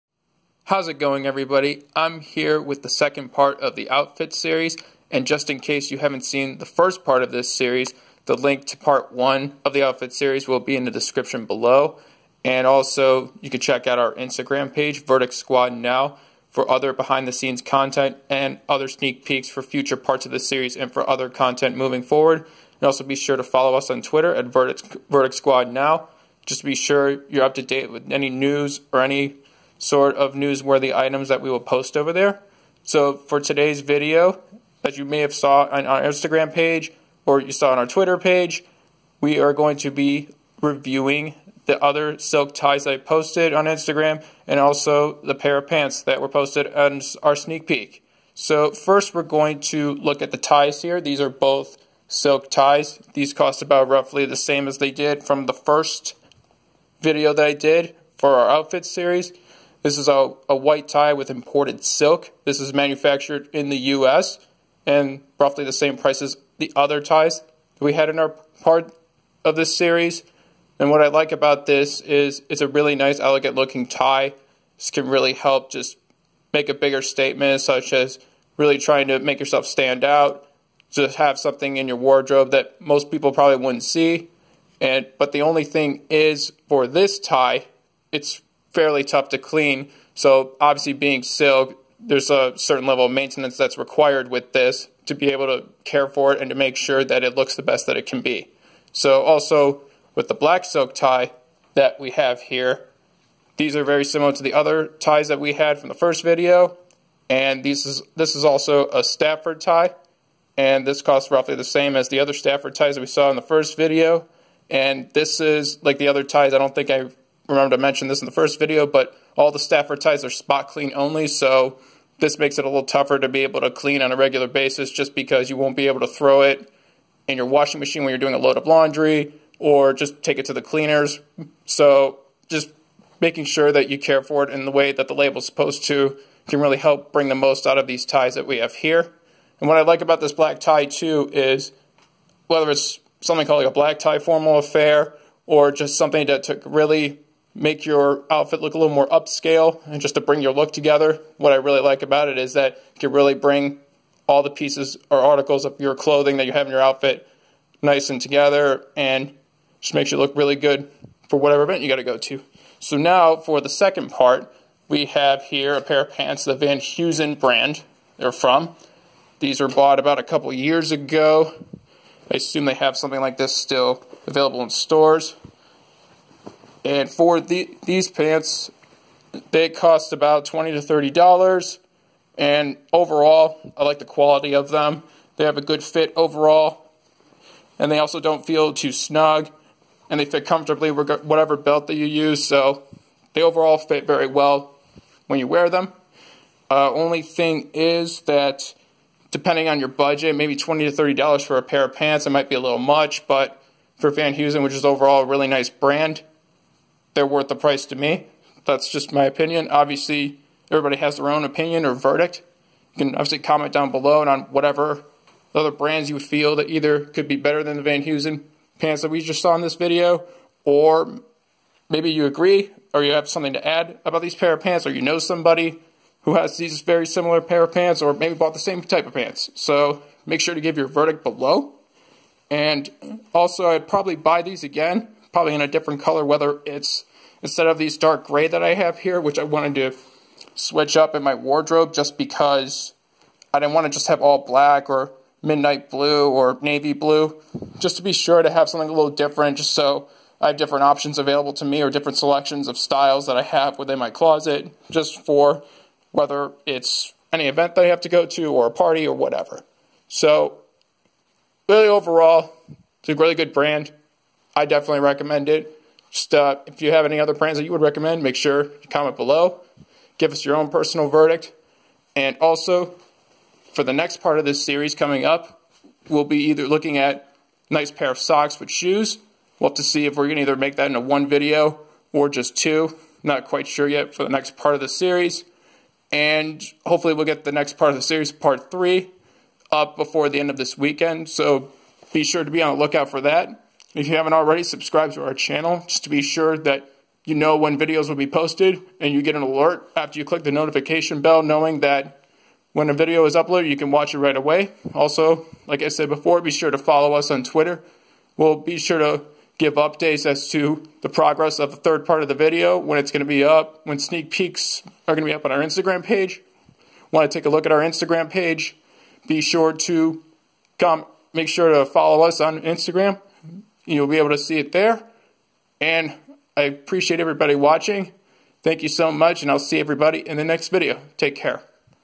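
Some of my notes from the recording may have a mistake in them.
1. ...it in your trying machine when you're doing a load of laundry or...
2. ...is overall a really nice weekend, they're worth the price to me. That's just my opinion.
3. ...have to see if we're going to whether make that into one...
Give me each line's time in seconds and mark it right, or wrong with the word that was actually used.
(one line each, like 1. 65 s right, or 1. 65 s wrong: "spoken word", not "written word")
1. 126 s wrong: "washing", not "trying"
2. 204 s wrong: "brand", not "weekend"
3. 279 s wrong: "either", not "whether".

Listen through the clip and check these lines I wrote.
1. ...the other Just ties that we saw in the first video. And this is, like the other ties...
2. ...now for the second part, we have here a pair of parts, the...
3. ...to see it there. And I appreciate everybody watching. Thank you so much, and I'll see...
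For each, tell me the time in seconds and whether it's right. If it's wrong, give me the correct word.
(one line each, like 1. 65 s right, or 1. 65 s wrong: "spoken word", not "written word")
1. 112 s wrong: "Stafford", not "Just"
2. 162 s wrong: "pants", not "parts"
3. 324 s right.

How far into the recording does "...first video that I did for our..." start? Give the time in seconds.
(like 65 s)
55 s.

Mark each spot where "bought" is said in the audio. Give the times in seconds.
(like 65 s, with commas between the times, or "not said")
169 s, 228 s.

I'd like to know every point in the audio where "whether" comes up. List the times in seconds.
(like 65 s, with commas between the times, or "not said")
142 s, 236 s, 256 s.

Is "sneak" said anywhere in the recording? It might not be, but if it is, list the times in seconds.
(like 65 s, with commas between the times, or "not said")
18 s, 47 s, 313 s.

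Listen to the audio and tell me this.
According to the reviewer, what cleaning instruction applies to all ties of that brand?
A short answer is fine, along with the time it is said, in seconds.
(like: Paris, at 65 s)
Spot clean only, at 120 s.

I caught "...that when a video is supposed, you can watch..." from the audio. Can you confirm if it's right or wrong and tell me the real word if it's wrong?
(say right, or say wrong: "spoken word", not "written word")
wrong: "uploaded", not "supposed".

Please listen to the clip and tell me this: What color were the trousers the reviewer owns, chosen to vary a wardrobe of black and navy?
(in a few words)
Dark gray.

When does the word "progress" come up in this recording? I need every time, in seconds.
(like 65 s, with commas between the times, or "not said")
311 s.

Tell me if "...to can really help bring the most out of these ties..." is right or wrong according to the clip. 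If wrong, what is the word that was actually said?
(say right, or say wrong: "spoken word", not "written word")
right.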